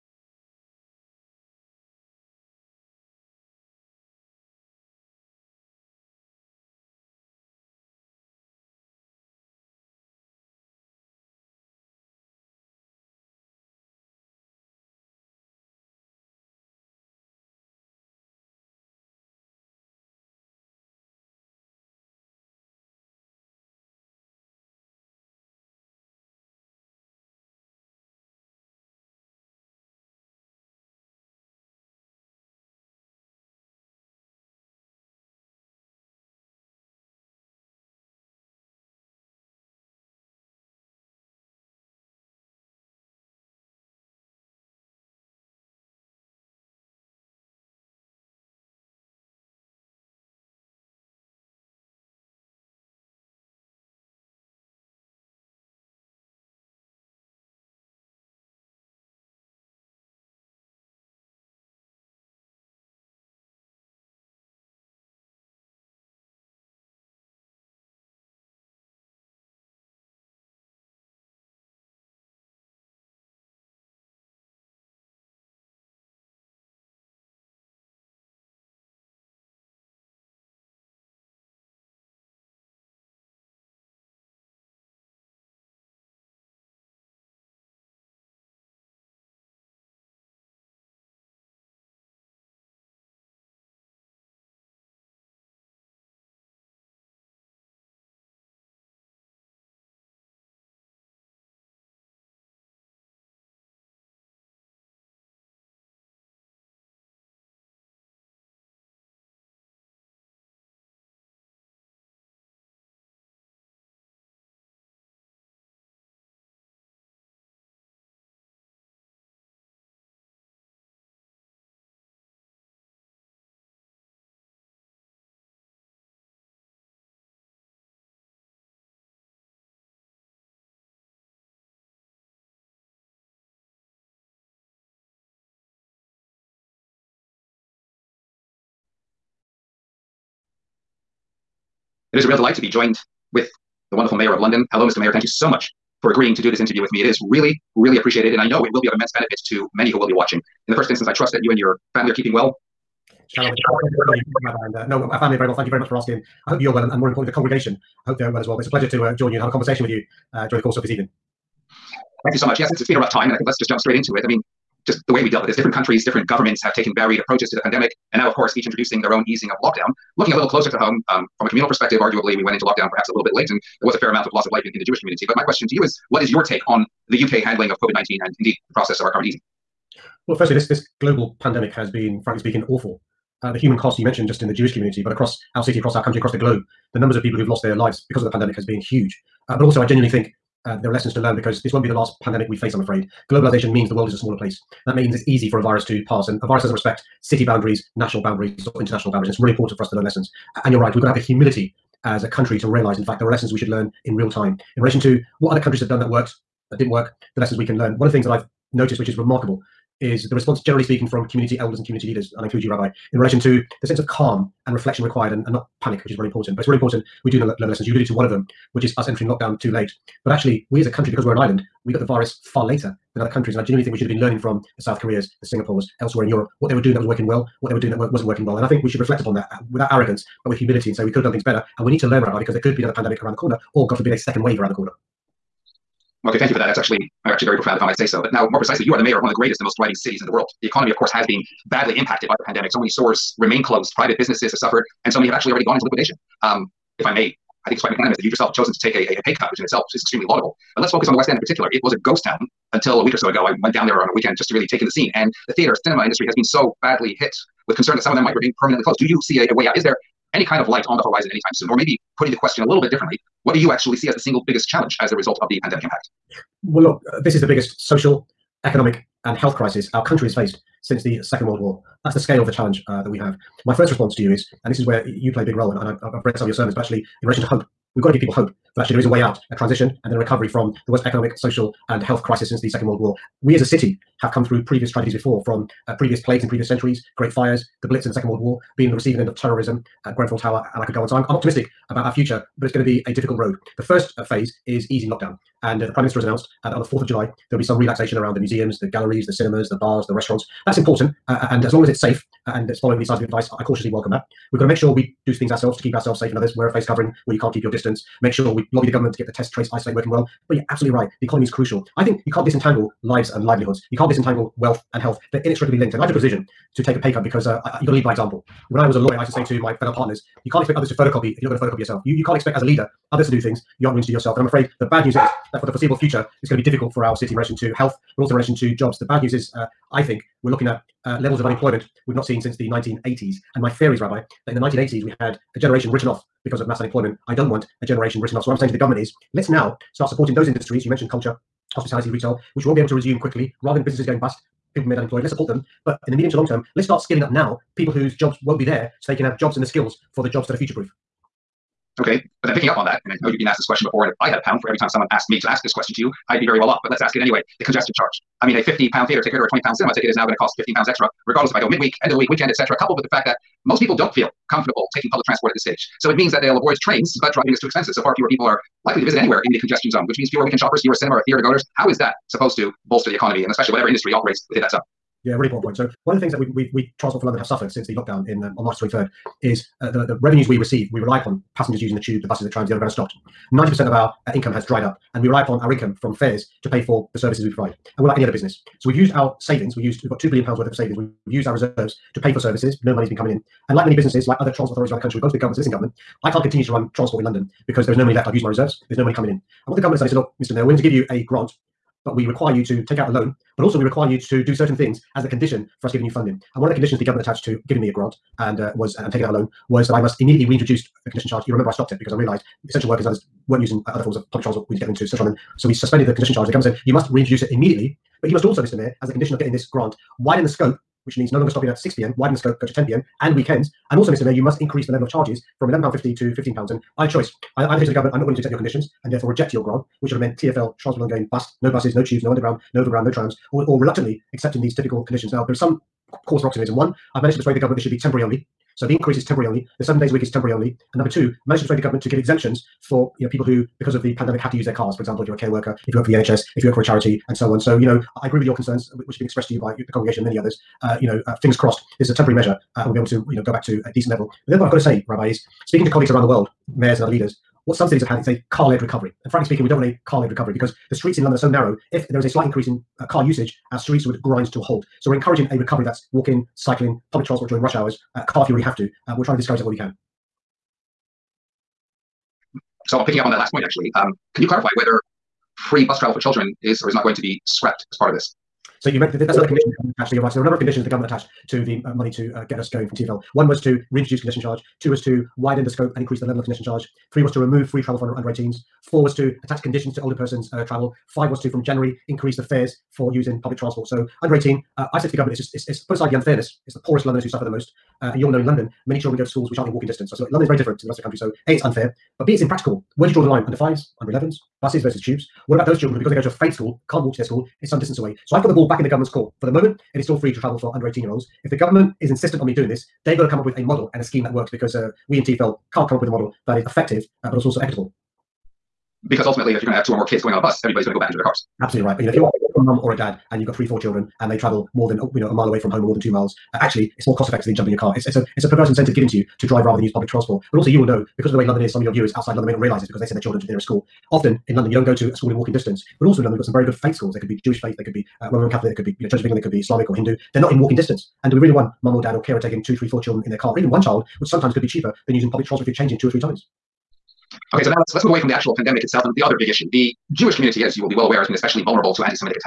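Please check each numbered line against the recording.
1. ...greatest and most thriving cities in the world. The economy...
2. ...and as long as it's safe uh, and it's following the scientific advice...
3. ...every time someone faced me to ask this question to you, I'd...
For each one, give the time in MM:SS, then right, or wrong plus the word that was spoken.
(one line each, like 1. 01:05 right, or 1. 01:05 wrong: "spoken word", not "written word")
1. 03:59 right
2. 05:01 right
3. 05:54 wrong: "asked", not "faced".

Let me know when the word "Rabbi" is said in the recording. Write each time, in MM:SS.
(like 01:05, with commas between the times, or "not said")
03:32, 03:52, 05:33, 07:35.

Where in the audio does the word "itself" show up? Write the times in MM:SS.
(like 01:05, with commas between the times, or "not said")
04:09, 09:08.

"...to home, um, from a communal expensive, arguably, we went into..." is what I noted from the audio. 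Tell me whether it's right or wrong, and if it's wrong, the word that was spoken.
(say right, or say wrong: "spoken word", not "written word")
wrong: "perspective", not "expensive".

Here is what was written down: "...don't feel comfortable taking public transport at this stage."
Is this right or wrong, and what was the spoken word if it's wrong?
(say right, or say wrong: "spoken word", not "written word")
right.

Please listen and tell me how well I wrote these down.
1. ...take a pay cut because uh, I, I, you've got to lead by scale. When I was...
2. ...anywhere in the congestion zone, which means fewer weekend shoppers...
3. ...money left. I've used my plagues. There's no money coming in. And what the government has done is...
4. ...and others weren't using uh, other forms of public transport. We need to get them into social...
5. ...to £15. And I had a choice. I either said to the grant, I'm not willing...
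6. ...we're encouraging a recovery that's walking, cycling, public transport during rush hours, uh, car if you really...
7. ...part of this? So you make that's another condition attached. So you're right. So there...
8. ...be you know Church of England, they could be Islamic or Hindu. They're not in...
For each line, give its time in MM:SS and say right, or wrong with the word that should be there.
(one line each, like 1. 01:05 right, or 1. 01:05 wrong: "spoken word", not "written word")
1. 05:16 wrong: "example", not "scale"
2. 06:09 right
3. 06:38 wrong: "reserves", not "plagues"
4. 06:53 right
5. 07:06 wrong: "government", not "grant"
6. 07:45 right
7. 07:57 right
8. 08:58 right.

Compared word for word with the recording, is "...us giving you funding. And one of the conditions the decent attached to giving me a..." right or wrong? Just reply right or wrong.
wrong.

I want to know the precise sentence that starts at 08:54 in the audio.
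Often in London, you don't go to a school in walking distance.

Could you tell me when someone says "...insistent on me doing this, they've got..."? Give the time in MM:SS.
08:32.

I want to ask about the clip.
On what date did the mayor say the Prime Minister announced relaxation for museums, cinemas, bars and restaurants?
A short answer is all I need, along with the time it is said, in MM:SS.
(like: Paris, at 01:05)
4th of July, at 04:56.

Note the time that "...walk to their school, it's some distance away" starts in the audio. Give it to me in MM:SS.
08:27.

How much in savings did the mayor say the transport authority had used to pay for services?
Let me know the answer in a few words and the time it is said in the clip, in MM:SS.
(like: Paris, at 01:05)
2 billion pounds, at 06:30.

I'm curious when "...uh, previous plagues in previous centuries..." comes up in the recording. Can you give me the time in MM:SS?
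04:45.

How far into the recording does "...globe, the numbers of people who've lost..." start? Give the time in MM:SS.
03:06.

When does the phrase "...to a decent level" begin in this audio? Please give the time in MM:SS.
07:33.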